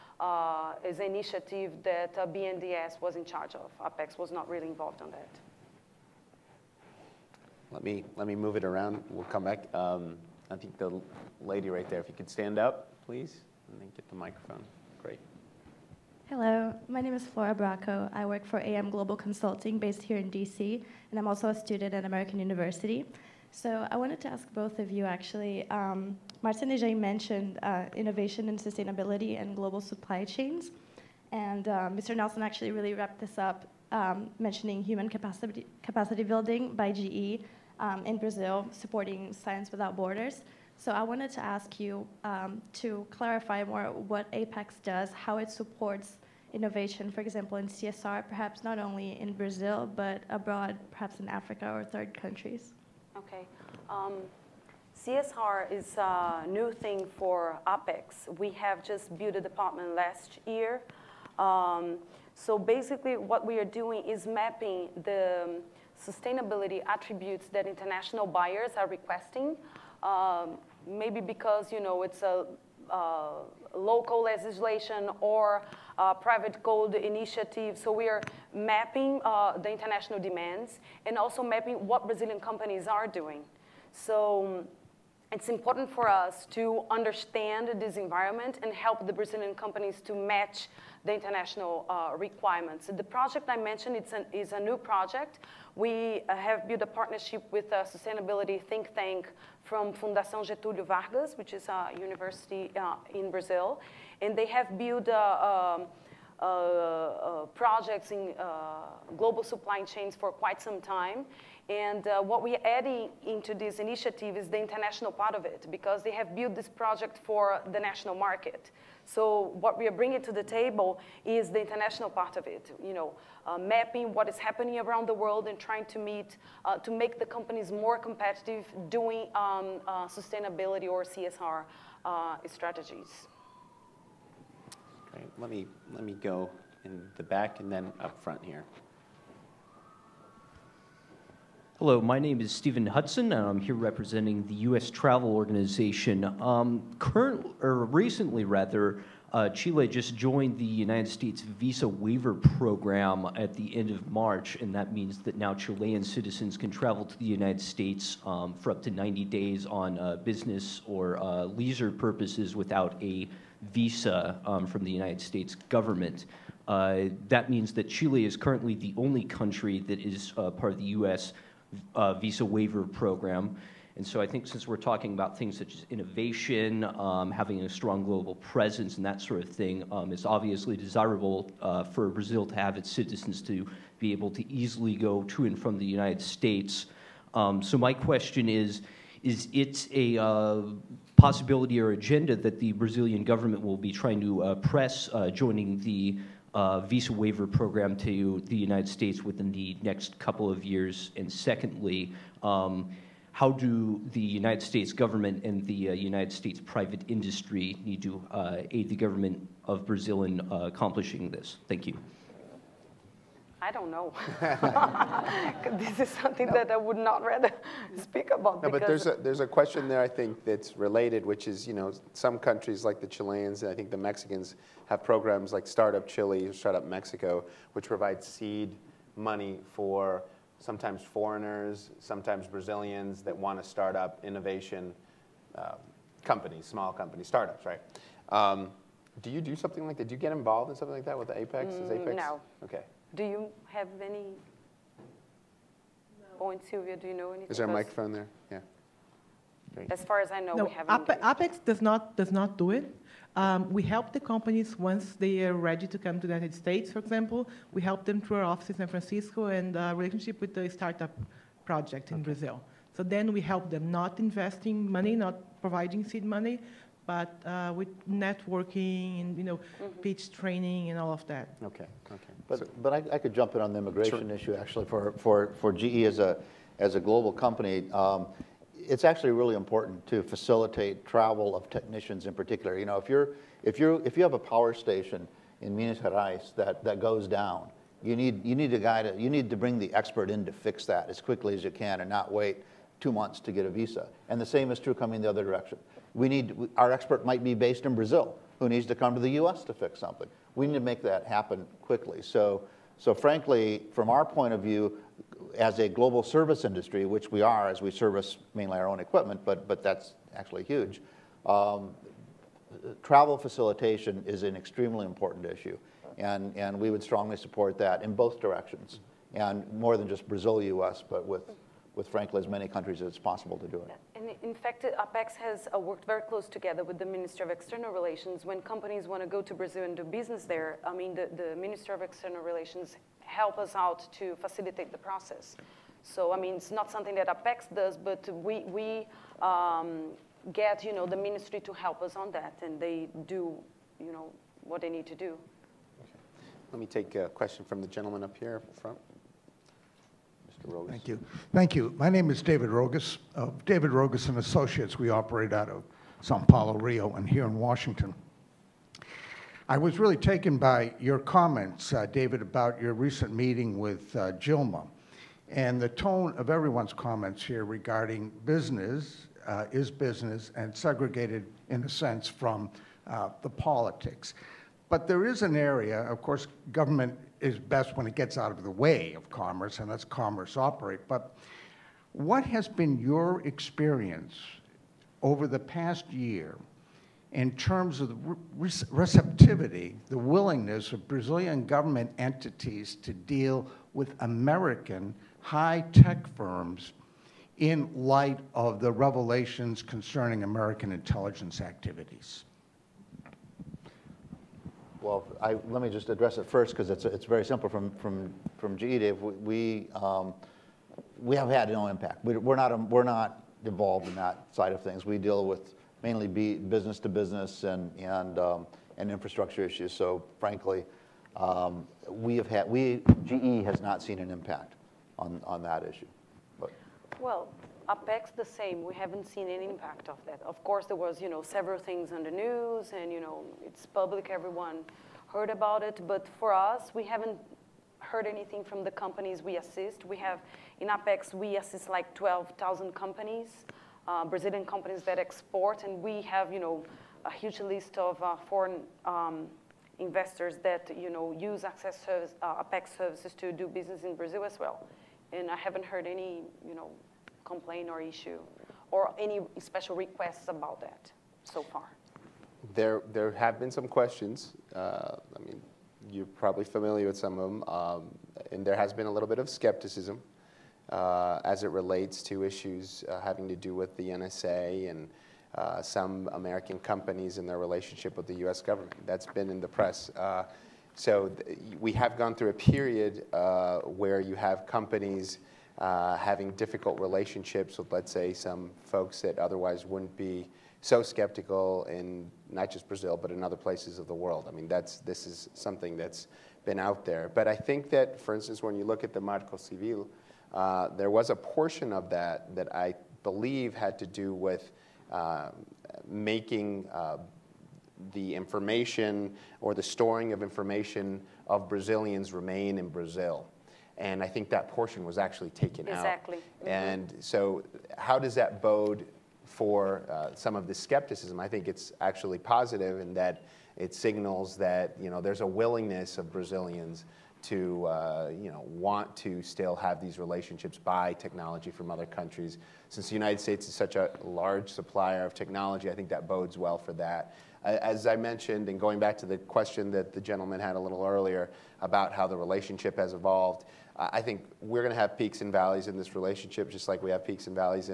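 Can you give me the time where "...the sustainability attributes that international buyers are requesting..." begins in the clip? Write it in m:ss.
1:05.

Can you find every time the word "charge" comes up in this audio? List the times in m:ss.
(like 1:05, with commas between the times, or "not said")
0:03.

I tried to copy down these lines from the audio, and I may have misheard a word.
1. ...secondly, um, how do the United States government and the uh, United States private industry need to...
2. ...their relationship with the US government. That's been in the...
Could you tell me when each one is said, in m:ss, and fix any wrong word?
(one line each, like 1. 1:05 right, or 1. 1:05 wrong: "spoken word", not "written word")
1. 3:21 right
2. 7:57 right.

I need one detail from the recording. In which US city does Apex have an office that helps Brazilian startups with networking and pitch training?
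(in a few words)
San Francisco.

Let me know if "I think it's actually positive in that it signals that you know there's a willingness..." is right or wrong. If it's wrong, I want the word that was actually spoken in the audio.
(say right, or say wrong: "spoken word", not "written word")
right.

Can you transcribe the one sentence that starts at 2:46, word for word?
Uh, that means that Chile is currently the only country that is uh, part of the U.S uh, visa waiver program.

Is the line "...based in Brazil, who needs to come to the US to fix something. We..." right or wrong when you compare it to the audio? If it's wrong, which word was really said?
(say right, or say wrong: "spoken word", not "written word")
right.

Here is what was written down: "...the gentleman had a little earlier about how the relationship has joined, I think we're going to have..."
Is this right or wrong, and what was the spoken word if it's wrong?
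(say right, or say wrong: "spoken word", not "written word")
wrong: "evolved", not "joined".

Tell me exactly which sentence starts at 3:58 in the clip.
Um, do you do something like that?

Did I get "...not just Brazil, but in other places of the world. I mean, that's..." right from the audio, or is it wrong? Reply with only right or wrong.
right.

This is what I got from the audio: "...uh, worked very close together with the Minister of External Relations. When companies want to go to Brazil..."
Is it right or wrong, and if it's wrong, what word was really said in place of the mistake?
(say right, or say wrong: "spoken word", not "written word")
right.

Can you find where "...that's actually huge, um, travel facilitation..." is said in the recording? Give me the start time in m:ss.
5:09.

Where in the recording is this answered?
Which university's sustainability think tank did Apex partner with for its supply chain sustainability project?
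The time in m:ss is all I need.
1:39.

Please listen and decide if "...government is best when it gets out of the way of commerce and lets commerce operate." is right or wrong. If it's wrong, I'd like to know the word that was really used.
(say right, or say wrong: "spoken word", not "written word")
right.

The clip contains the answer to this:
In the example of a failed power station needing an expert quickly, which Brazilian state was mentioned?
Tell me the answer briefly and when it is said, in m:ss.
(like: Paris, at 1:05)
Minas Gerais, at 4:45.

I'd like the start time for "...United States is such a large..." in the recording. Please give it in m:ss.
8:53.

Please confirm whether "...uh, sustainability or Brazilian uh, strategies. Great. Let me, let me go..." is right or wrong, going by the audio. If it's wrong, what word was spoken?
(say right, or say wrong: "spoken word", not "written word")
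wrong: "CSR", not "Brazilian".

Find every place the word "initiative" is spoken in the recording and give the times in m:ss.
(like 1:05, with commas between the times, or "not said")
0:01, 1:16, 1:53.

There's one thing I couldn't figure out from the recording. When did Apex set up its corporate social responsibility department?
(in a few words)
last year.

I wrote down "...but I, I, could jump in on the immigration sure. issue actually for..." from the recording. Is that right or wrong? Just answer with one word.
right.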